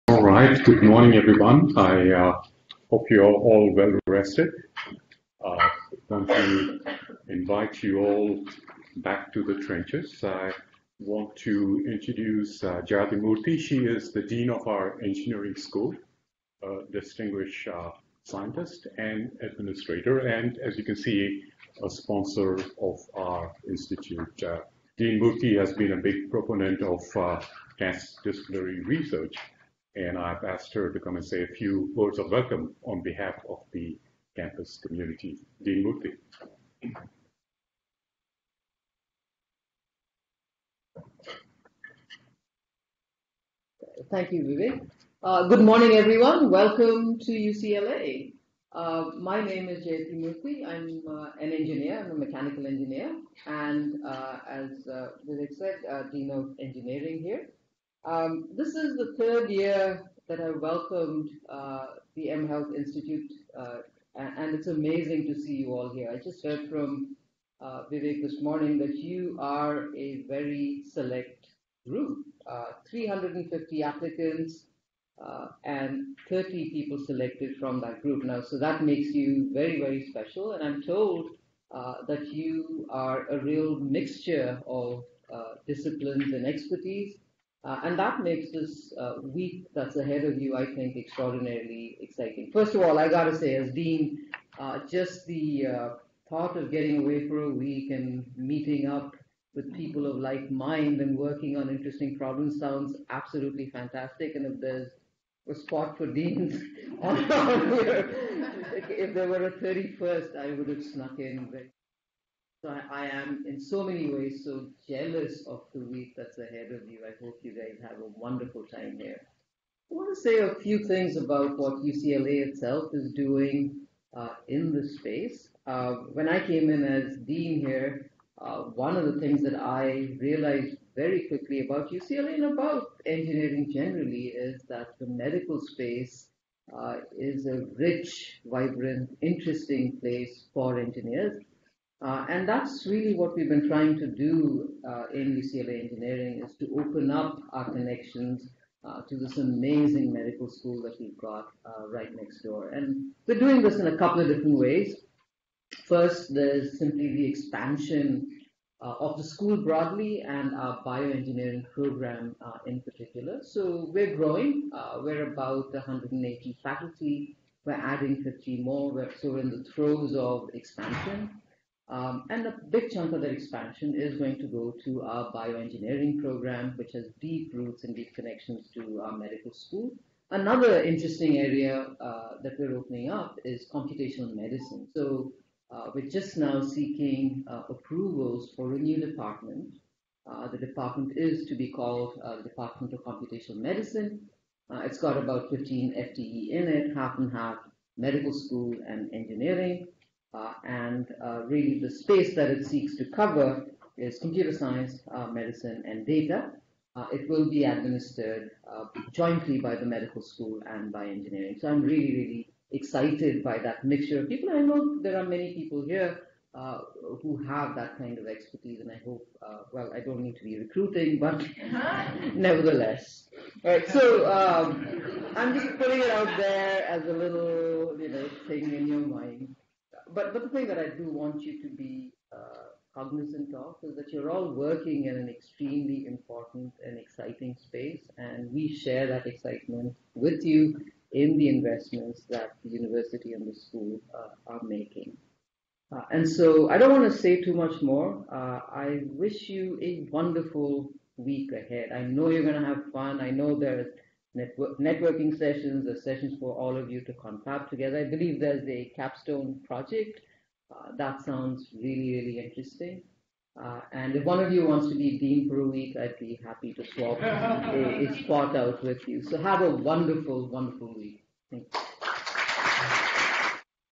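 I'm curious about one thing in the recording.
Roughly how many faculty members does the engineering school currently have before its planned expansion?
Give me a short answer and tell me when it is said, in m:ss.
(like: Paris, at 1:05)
180, at 2:45.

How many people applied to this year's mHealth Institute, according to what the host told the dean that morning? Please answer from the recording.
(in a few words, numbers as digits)
350.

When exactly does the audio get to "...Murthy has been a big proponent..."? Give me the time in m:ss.
0:25.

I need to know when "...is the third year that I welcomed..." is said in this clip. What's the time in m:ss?
0:58.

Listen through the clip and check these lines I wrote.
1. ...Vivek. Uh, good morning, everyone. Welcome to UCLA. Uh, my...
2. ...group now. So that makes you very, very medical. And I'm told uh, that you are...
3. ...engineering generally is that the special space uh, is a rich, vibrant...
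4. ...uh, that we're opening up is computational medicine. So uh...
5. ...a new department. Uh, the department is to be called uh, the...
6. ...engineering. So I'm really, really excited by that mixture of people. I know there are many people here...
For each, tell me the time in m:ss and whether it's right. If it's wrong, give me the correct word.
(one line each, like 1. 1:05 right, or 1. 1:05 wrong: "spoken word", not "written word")
1. 0:44 right
2. 1:18 wrong: "special", not "medical"
3. 2:13 wrong: "medical", not "special"
4. 3:01 right
5. 3:08 right
6. 3:31 right.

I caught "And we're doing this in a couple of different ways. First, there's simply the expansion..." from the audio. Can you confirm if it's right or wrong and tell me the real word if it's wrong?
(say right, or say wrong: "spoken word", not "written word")
right.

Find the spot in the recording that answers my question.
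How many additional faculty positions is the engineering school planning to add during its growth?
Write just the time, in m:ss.
2:48.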